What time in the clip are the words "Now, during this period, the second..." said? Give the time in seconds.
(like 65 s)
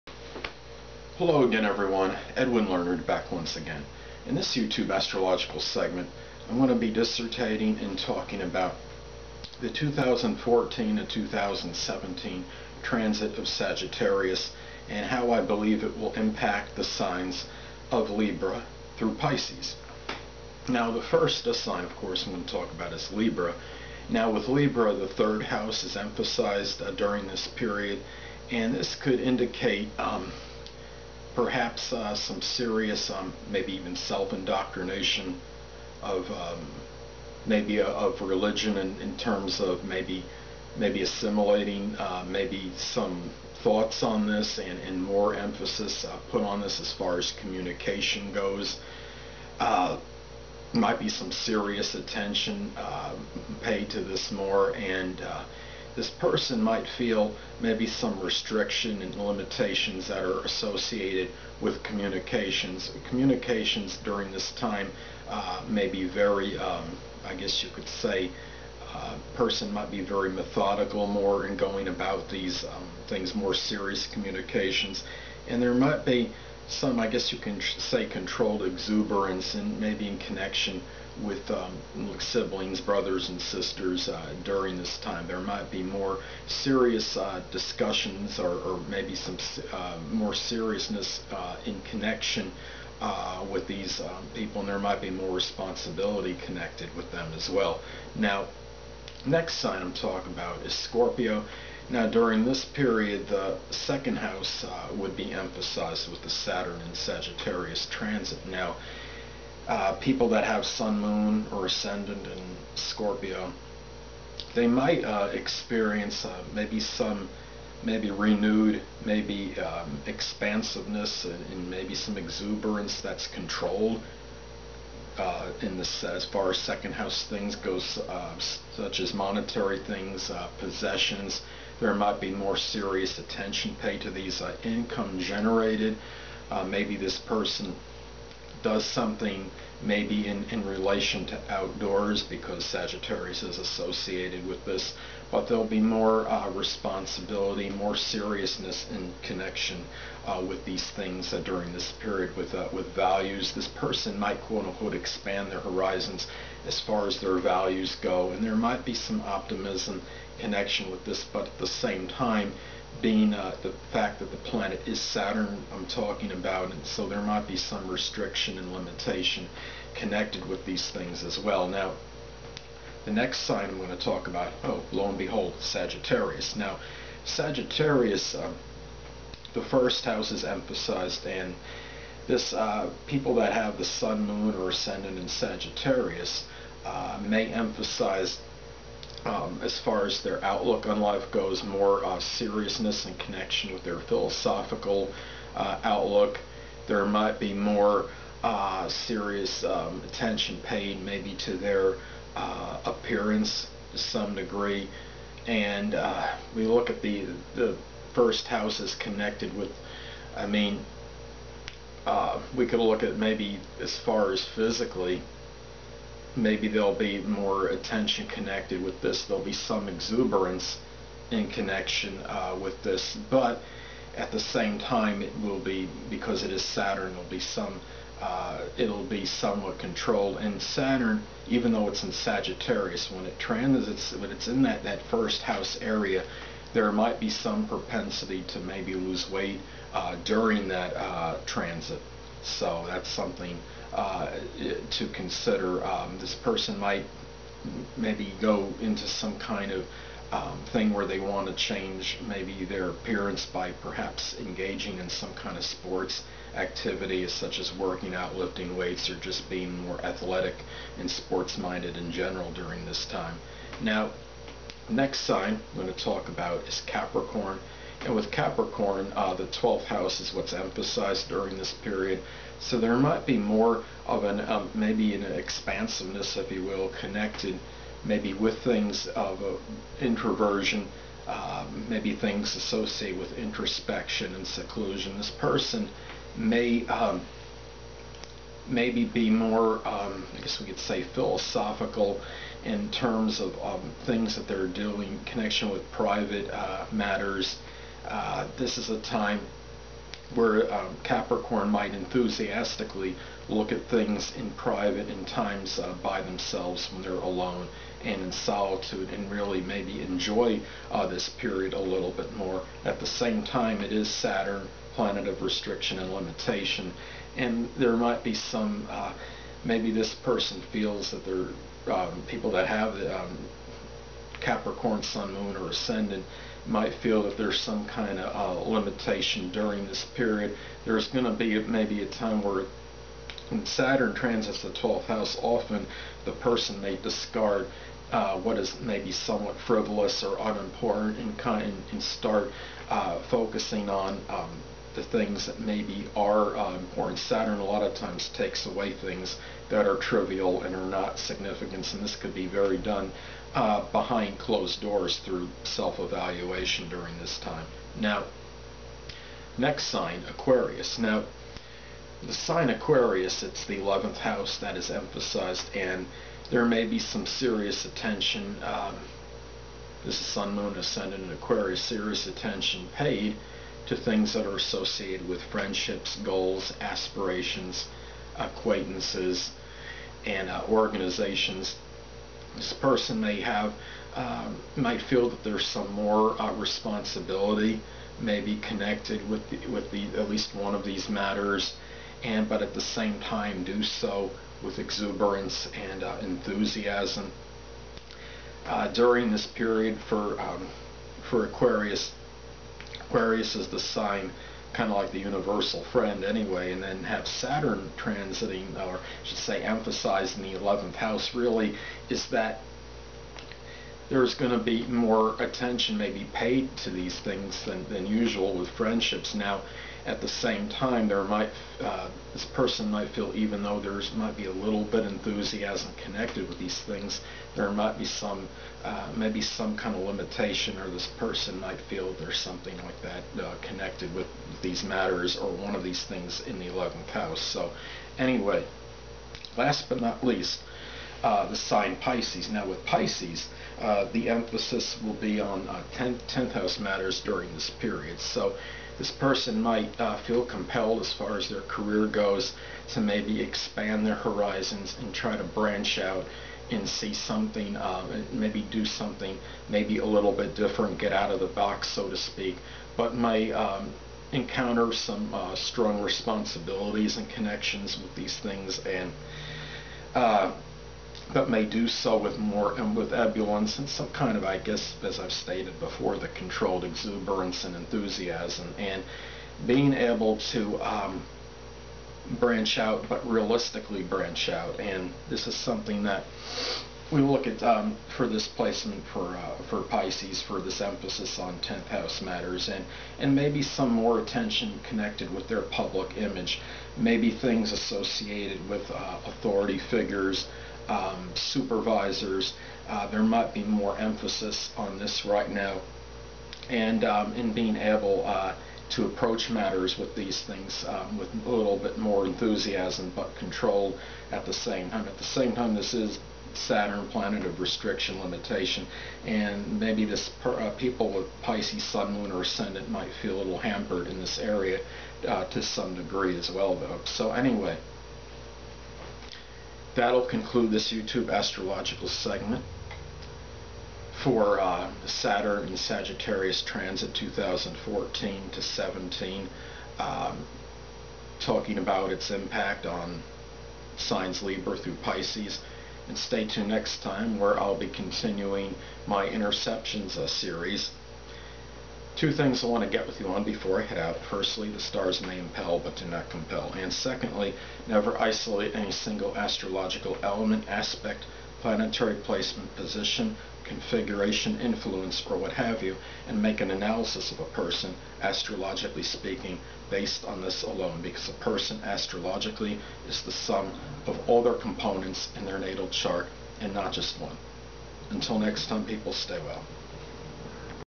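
101 s.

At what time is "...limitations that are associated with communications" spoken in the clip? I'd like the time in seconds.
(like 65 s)
59 s.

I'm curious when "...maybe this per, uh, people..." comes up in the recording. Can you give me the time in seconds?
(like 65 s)
519 s.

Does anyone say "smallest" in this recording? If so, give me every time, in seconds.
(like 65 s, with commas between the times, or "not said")
not said.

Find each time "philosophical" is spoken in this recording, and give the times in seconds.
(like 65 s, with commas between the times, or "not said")
193 s, 291 s.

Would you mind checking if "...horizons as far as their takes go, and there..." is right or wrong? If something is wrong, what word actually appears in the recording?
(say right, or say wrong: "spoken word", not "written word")
wrong: "values", not "takes".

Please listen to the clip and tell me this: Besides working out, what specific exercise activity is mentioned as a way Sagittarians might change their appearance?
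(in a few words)
lifting weights.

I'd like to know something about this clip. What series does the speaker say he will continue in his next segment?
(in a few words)
Interceptions.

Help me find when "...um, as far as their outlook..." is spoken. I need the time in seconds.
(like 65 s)
189 s.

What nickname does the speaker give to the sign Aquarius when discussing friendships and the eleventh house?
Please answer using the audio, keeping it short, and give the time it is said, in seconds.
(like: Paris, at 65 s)
the universal friend, at 405 s.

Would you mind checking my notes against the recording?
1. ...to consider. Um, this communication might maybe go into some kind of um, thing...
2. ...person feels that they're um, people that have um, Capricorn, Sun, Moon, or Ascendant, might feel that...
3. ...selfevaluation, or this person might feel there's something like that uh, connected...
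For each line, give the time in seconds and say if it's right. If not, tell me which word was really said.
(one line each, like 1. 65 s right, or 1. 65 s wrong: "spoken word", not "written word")
1. 244 s wrong: "person", not "communication"
2. 320 s right
3. 430 s wrong: "limitation", not "selfevaluation".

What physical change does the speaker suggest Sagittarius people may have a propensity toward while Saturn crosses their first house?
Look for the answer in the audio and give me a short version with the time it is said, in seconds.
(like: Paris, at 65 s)
lose weight, at 238 s.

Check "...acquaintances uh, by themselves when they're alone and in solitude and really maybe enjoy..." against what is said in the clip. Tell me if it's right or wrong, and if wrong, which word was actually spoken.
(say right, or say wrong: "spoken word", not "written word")
wrong: "times", not "acquaintances".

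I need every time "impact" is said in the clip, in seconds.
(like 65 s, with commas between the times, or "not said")
16 s, 542 s.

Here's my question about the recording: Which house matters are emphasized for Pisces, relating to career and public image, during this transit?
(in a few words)
10th house.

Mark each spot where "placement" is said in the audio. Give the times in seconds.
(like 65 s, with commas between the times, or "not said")
488 s, 562 s.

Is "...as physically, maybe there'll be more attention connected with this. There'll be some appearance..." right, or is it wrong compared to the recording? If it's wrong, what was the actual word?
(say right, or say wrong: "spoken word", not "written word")
wrong: "exuberance", not "appearance".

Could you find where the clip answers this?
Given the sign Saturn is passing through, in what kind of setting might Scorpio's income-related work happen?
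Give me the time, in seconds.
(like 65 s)
140 s.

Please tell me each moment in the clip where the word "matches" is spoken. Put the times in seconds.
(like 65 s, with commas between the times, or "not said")
not said.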